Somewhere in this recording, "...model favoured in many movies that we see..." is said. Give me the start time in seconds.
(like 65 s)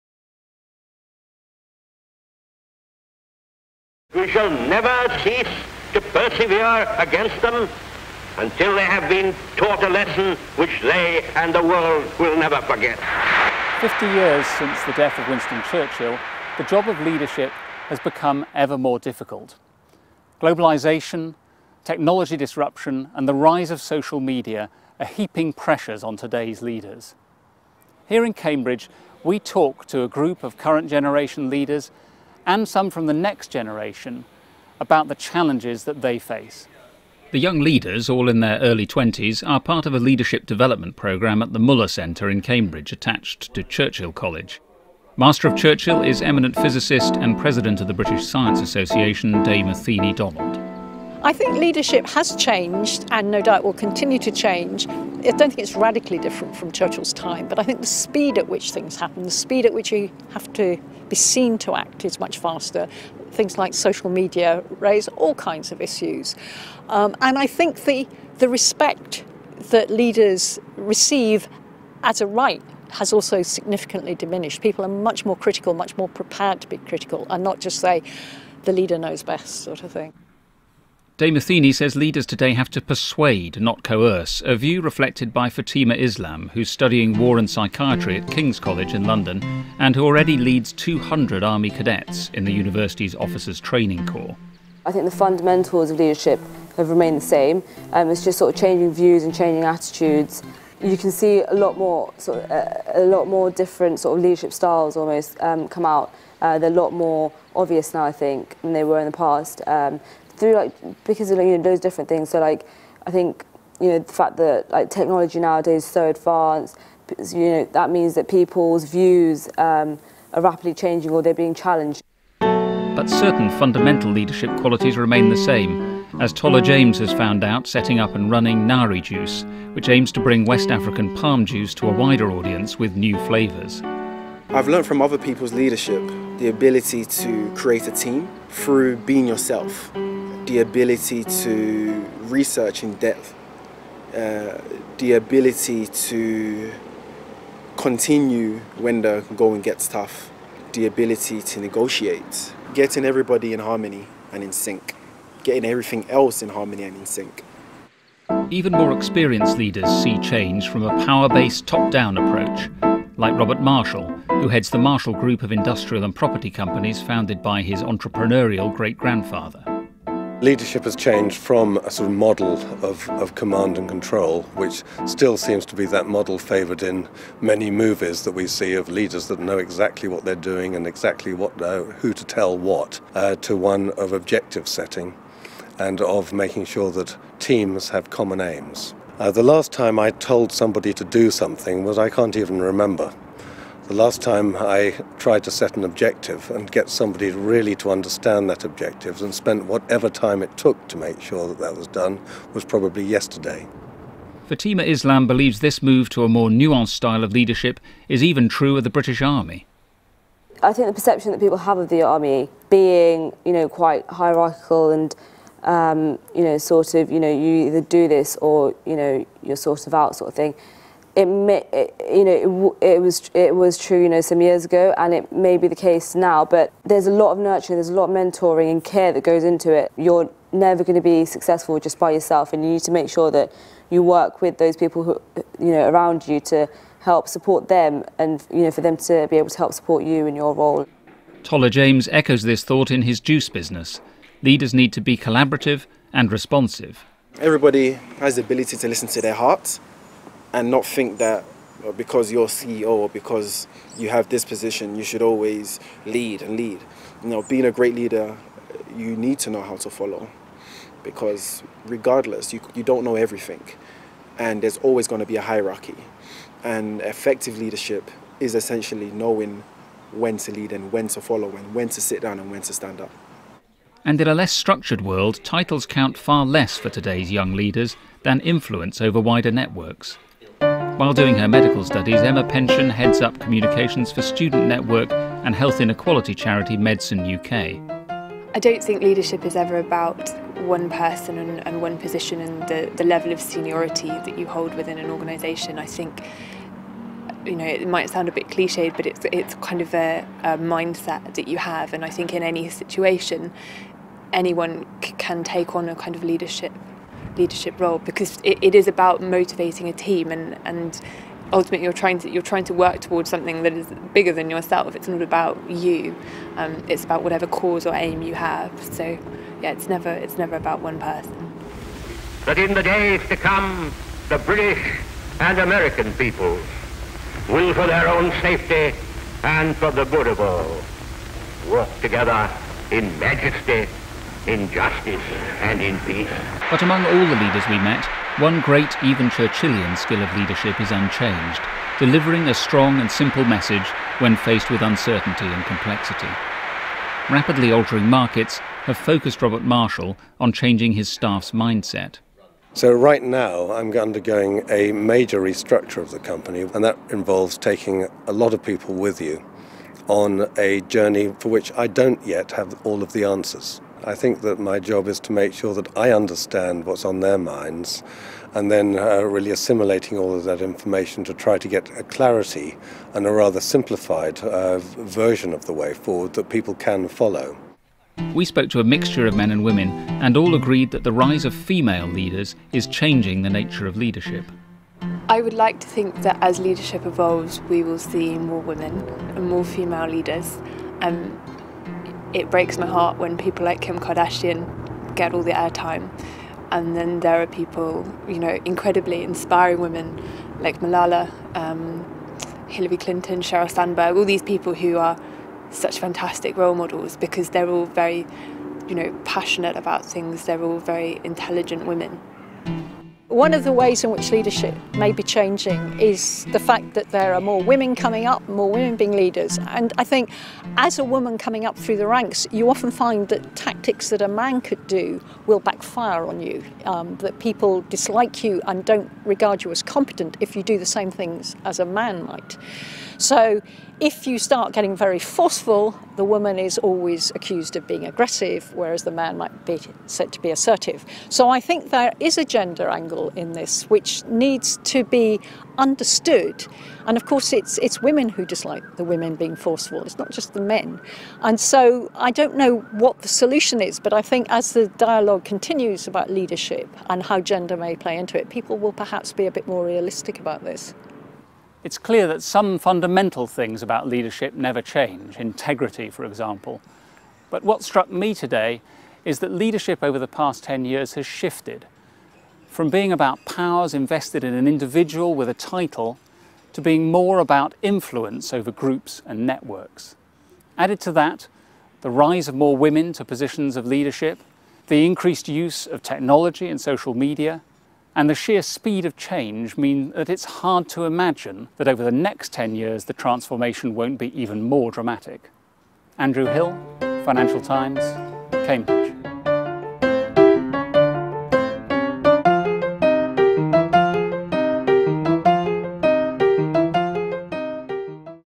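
176 s.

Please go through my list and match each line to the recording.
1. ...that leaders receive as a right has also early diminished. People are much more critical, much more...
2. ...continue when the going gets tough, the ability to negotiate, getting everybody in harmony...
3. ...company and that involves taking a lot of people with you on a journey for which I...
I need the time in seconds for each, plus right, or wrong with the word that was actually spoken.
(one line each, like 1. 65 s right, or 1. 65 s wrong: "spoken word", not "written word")
1. 69 s wrong: "significantly", not "early"
2. 147 s right
3. 356 s right.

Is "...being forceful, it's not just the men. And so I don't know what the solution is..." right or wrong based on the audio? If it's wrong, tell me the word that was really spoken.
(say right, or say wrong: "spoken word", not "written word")
right.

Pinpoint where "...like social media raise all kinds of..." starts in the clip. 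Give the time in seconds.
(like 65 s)
63 s.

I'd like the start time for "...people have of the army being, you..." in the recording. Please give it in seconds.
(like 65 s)
211 s.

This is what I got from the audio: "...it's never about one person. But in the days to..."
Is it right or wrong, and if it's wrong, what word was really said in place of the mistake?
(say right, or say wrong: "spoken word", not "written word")
right.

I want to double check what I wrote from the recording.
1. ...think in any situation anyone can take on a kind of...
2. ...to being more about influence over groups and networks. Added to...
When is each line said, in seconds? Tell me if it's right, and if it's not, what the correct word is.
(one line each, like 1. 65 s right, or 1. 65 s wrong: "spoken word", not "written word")
1. 302 s right
2. 476 s right.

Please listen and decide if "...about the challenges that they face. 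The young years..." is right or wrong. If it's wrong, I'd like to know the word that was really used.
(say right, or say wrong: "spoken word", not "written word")
wrong: "leaders", not "years".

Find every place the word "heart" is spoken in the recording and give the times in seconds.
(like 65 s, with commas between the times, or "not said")
249 s, 392 s.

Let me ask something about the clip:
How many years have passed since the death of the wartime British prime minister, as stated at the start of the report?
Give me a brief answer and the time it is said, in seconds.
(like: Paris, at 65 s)
50, at 13 s.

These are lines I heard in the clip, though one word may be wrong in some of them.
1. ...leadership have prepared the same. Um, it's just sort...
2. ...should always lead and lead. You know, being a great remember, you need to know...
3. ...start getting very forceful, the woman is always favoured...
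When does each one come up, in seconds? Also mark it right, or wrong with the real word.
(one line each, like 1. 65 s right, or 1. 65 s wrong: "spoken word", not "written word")
1. 95 s wrong: "remained", not "prepared"
2. 255 s wrong: "leader", not "remember"
3. 434 s wrong: "accused", not "favoured".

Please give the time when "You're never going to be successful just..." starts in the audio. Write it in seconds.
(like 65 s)
229 s.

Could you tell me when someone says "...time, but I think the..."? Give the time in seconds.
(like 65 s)
57 s.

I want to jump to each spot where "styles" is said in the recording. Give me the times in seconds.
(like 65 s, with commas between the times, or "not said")
104 s, 206 s.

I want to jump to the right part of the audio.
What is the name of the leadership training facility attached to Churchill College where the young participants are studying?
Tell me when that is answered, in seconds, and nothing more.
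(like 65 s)
41 s.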